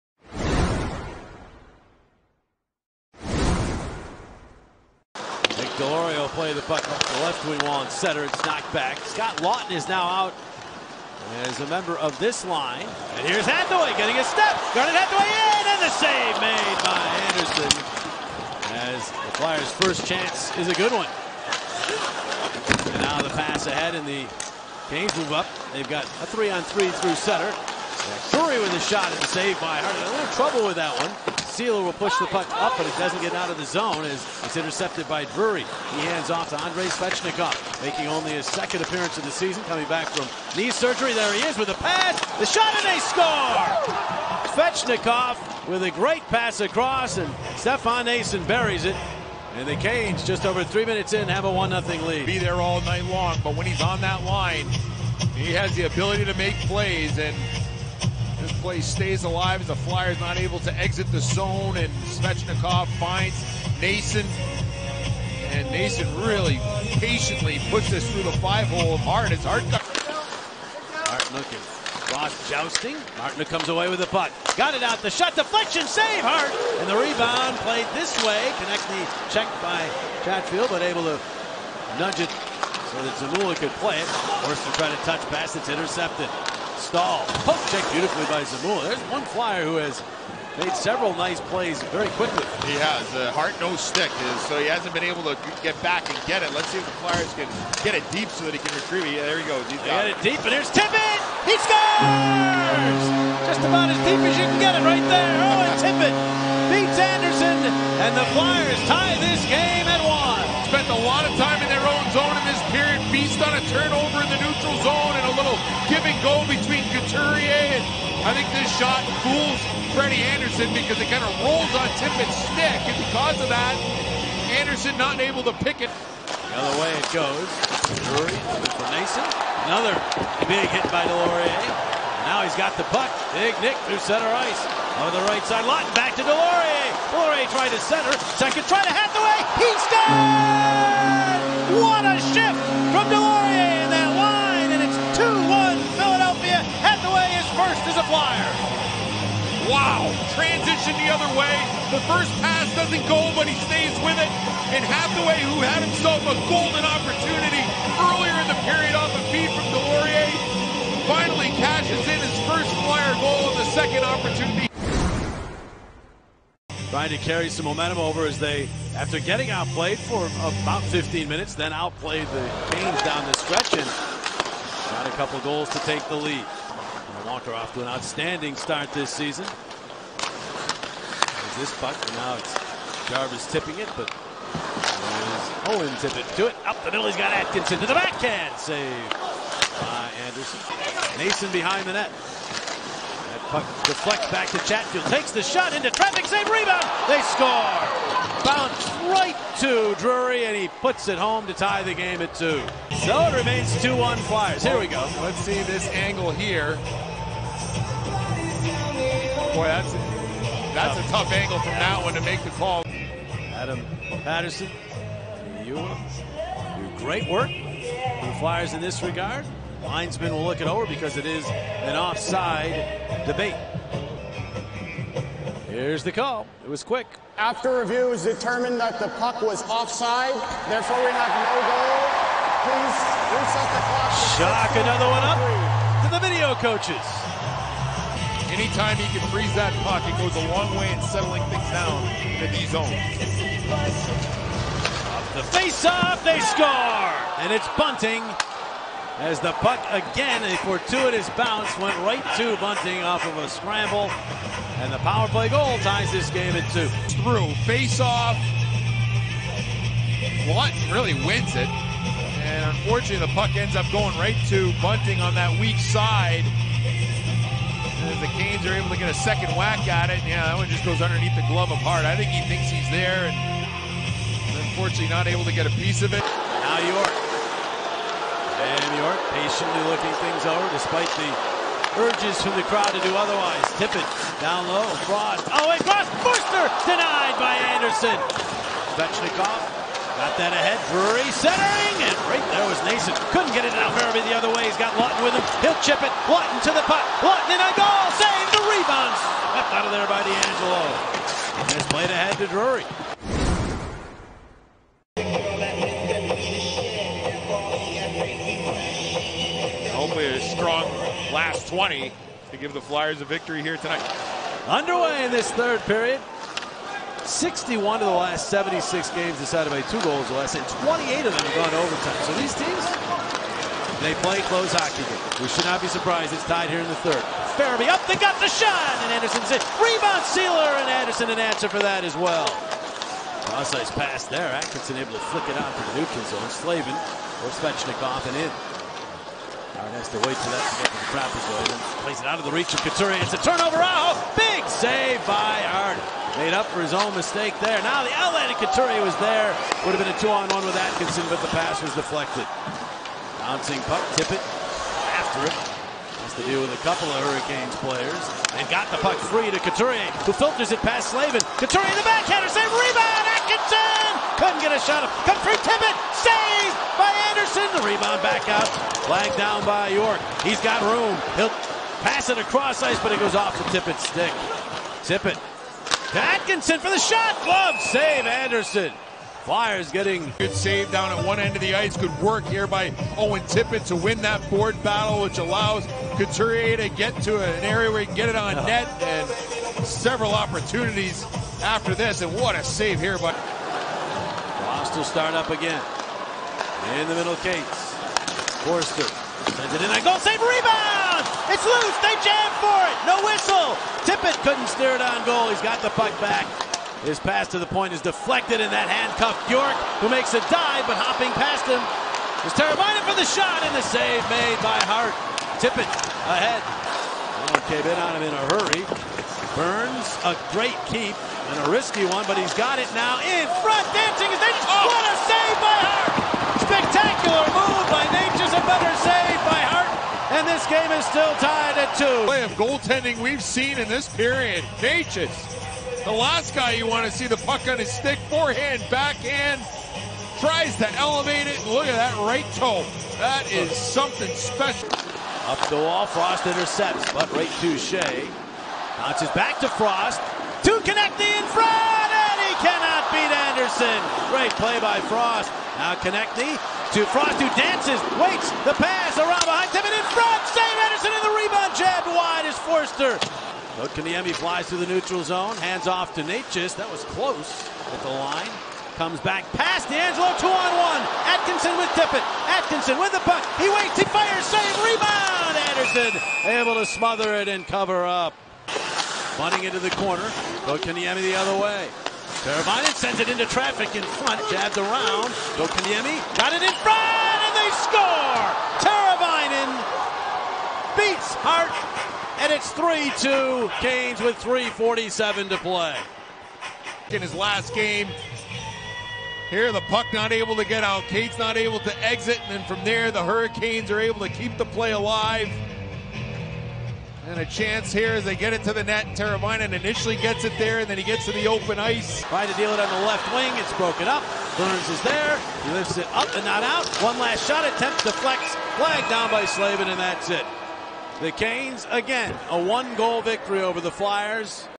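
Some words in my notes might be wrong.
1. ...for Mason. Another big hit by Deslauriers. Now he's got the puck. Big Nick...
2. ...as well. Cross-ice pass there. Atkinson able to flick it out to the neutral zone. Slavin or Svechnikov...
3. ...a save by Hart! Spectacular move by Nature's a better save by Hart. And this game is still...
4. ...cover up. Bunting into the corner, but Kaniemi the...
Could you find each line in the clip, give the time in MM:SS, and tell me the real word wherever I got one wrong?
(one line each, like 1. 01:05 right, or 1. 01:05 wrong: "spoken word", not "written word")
1. 02:08 right
2. 05:32 right
3. 07:05 right
4. 07:57 right.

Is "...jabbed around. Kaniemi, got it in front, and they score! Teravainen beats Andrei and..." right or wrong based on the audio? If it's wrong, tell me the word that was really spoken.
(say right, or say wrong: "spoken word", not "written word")
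wrong: "Hart", not "Andrei".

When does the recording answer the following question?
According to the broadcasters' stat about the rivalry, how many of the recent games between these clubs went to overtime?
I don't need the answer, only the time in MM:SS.
05:20.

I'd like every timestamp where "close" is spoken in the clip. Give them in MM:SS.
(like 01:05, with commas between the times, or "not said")
05:24, 07:47.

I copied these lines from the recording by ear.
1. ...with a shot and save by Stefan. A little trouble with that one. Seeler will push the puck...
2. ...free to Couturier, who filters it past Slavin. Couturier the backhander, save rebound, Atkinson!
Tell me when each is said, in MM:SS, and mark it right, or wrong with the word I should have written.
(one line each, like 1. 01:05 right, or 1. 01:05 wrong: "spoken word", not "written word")
1. 00:28 wrong: "Harding", not "Stefan"
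2. 05:59 right.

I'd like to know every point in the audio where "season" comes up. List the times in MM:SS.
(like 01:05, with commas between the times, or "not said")
00:39, 02:59.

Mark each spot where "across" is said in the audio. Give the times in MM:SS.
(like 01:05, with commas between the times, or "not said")
00:46, 06:12.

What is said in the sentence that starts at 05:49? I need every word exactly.
Would have been a two-on-one with Atkinson, but the pass was deflected.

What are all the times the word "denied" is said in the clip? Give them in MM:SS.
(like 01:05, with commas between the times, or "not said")
04:46.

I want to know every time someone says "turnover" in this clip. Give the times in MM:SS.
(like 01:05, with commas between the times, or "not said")
01:53, 05:43.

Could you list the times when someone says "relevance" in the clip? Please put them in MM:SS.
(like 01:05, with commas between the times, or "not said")
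not said.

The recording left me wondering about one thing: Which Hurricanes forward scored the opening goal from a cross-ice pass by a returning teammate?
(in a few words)
Stefan Noesen.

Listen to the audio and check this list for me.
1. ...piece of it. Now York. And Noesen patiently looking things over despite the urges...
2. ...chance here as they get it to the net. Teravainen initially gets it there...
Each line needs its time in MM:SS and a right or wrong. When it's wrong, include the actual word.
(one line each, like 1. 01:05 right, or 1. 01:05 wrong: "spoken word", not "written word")
1. 04:35 wrong: "York", not "Noesen"
2. 08:27 right.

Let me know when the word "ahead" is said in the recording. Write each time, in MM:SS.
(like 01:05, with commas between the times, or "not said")
00:23, 04:50, 06:56.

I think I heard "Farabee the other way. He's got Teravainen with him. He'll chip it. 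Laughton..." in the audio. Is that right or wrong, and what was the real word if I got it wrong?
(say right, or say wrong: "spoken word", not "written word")
wrong: "Laughton", not "Teravainen".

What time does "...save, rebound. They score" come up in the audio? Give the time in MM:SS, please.
03:16.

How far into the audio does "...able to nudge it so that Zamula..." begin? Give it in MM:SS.
01:20.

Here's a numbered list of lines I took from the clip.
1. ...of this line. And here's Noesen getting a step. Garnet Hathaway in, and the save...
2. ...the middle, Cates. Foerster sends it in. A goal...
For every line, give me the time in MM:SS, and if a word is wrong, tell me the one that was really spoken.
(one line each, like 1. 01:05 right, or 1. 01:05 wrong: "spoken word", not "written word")
1. 00:11 wrong: "Hathaway", not "Noesen"
2. 06:37 right.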